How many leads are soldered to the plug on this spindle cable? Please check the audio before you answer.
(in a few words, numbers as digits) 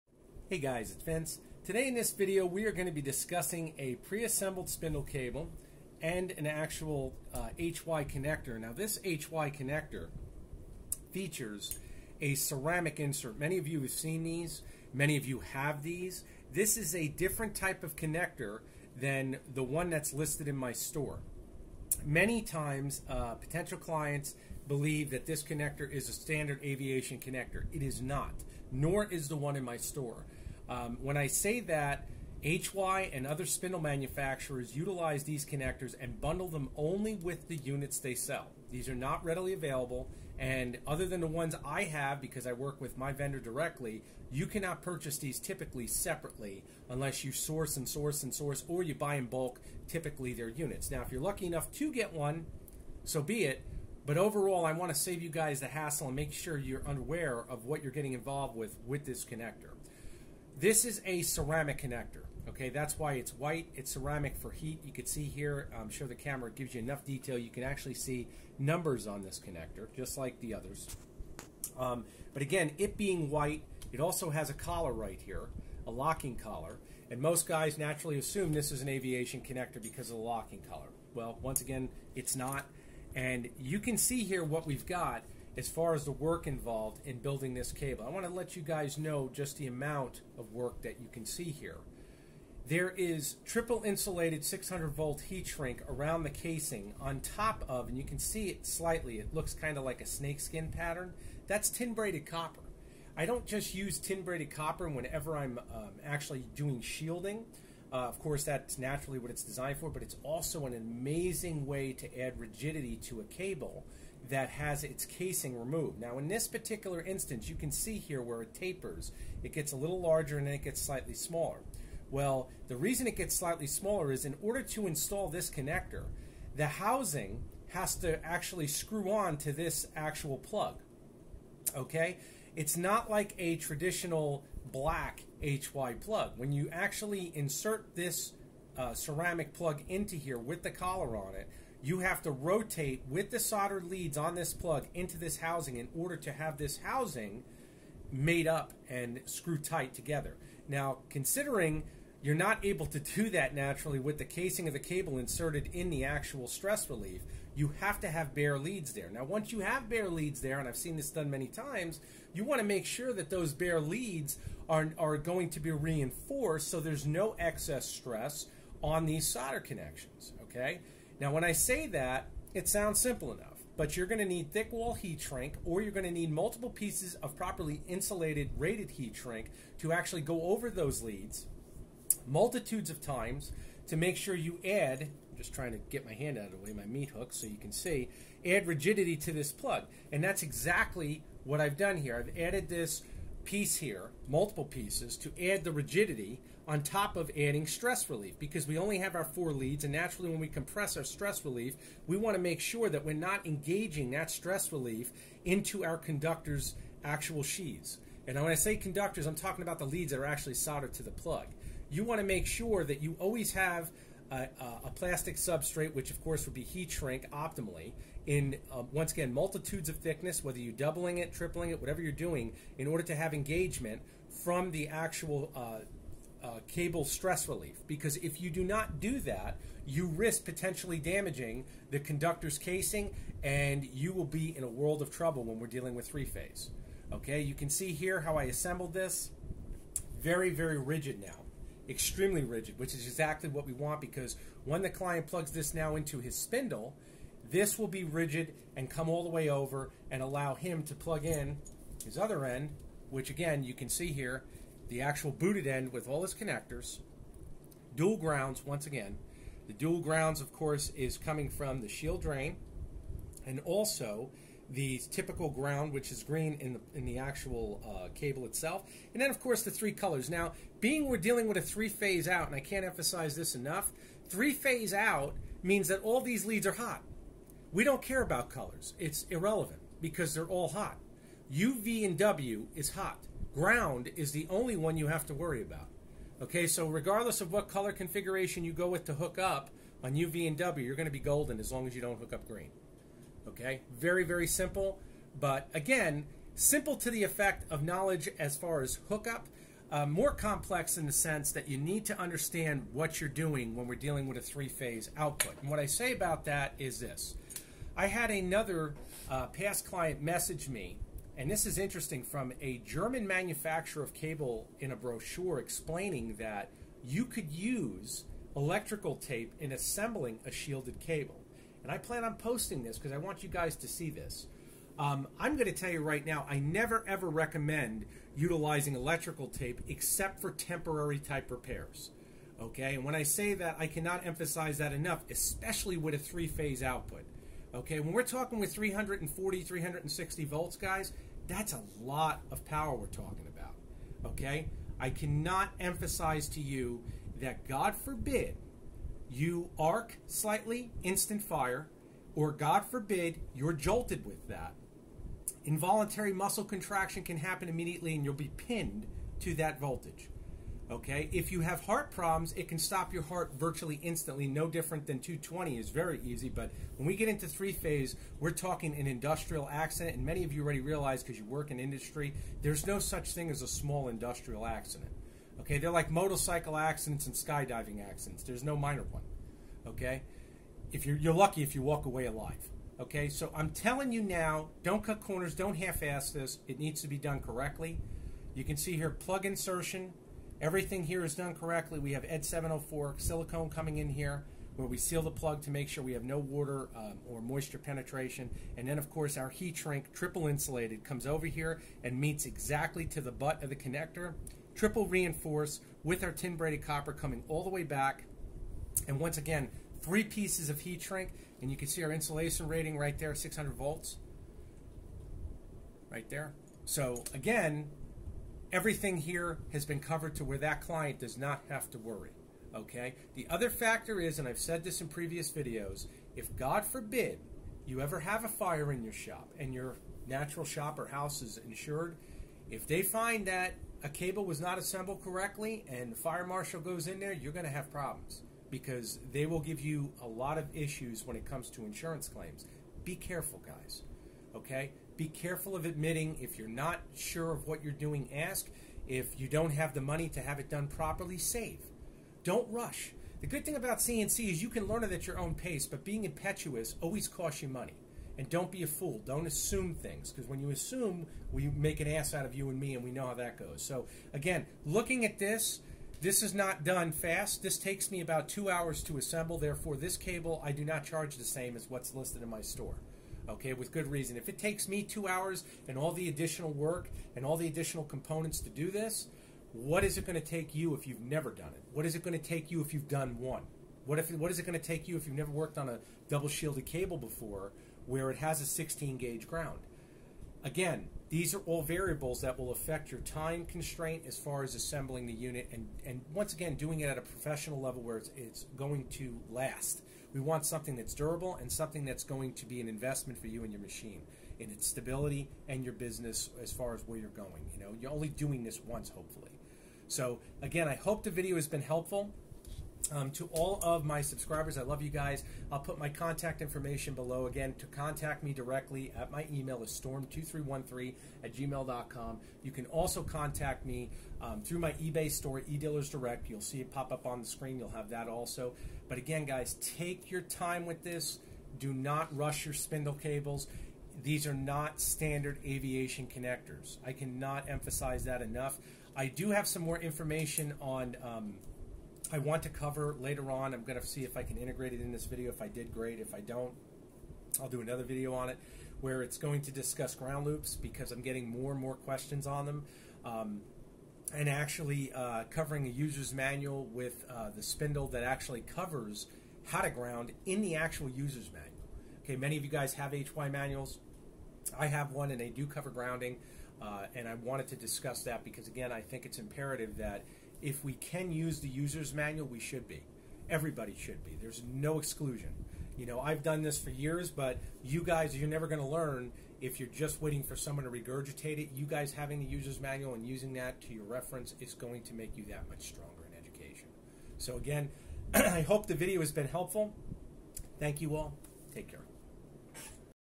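Four.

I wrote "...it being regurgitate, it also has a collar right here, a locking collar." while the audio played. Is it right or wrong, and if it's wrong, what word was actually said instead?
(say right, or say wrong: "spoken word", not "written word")
wrong: "white", not "regurgitate".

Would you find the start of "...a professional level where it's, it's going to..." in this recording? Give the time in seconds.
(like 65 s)
497 s.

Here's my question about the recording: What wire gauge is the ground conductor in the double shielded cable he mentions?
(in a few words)
16 gauge.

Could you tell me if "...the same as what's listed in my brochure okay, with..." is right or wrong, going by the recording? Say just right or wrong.
wrong.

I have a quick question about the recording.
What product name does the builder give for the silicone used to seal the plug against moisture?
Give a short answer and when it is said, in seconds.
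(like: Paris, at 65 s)
ED 704, at 392 s.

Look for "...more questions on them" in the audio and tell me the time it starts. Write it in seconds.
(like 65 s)
551 s.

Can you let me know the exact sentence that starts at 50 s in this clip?
Now, if you're lucky enough to get one, so be it.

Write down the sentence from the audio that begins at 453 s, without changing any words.
The good thing about CNC is you can learn it at your own pace, but being impetuous always costs you money.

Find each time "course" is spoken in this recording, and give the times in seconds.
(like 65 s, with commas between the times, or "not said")
108 s, 216 s, 260 s, 269 s, 399 s.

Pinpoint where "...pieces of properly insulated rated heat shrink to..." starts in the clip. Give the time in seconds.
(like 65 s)
176 s.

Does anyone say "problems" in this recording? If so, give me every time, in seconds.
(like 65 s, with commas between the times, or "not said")
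362 s, 437 s.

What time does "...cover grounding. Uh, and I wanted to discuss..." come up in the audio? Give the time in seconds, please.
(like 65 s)
565 s.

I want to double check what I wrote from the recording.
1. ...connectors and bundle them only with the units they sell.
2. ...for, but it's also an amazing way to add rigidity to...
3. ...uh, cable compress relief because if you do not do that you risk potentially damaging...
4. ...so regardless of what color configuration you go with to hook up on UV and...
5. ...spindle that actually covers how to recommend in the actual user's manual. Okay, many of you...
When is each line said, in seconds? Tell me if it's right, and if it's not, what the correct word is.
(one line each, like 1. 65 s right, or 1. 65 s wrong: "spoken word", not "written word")
1. 35 s right
2. 109 s right
3. 226 s wrong: "stress", not "compress"
4. 286 s right
5. 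557 s wrong: "ground", not "recommend".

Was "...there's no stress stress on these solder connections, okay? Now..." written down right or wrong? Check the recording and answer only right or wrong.
wrong.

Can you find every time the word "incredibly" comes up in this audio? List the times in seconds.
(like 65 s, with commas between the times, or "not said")
not said.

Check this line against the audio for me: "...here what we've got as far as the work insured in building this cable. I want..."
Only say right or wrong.
wrong.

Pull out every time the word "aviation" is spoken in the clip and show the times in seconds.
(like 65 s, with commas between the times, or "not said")
26 s, 78 s, 535 s.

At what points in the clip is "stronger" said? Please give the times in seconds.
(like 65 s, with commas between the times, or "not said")
585 s.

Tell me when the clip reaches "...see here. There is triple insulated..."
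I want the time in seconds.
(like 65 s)
91 s.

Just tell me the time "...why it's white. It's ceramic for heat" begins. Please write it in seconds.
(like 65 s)
62 s.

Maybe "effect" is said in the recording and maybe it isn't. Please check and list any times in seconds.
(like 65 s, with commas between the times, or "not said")
297 s.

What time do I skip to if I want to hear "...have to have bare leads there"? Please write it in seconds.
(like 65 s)
157 s.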